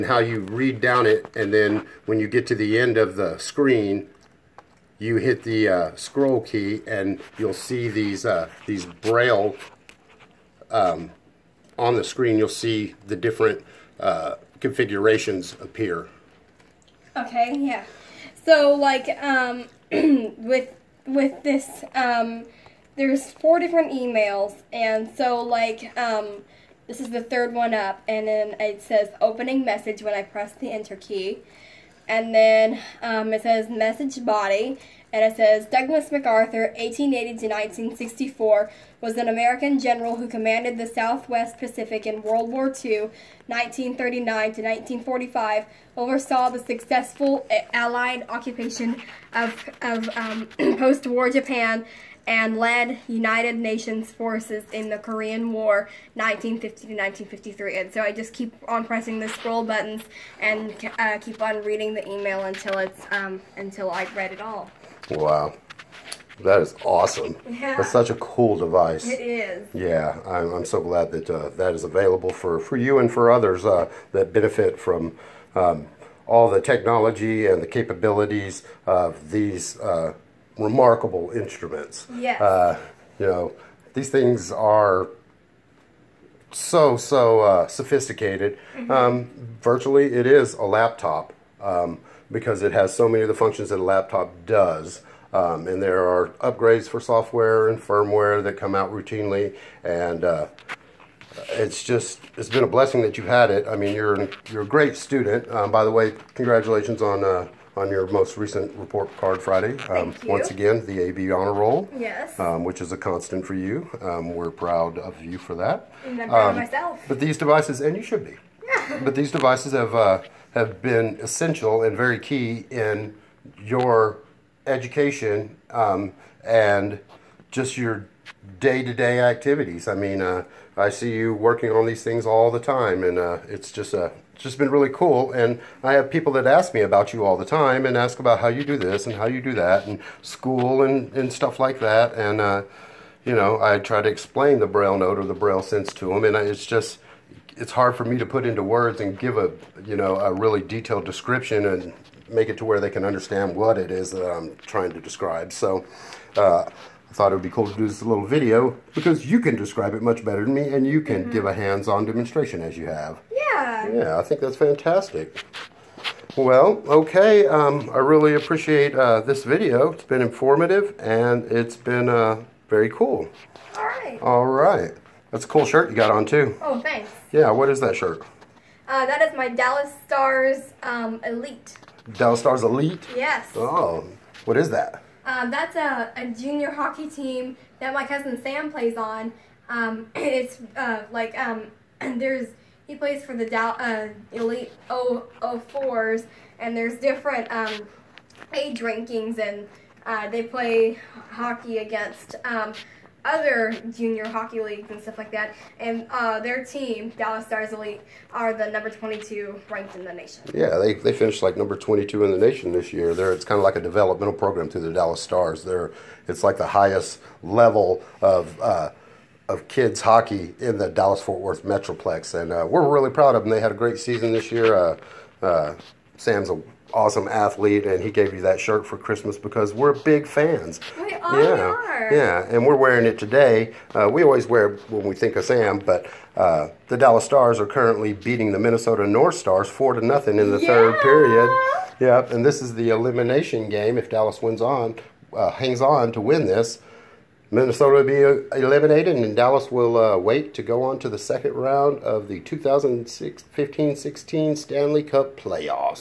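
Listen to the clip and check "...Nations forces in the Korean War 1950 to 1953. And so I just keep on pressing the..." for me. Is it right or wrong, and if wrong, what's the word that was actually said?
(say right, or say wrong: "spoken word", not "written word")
right.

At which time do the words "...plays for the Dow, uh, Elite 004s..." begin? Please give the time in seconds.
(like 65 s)
192 s.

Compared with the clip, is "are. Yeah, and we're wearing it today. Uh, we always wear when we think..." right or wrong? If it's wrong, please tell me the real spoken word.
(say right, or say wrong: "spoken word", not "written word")
right.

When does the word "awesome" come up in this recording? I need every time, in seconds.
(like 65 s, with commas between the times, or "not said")
66 s, 226 s.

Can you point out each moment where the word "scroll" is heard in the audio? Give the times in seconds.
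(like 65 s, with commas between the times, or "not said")
5 s, 59 s.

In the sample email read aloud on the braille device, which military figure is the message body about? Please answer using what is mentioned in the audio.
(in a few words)
Douglas MacArthur.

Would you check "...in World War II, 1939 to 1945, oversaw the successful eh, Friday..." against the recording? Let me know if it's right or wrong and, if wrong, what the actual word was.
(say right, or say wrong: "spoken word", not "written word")
wrong: "Allied", not "Friday".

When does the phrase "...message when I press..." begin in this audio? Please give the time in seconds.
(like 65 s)
29 s.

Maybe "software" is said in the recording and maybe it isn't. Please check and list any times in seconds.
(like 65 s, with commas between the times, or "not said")
96 s.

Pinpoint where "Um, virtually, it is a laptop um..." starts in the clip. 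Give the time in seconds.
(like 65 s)
88 s.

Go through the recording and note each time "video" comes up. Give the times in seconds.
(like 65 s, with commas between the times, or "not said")
158 s, 169 s.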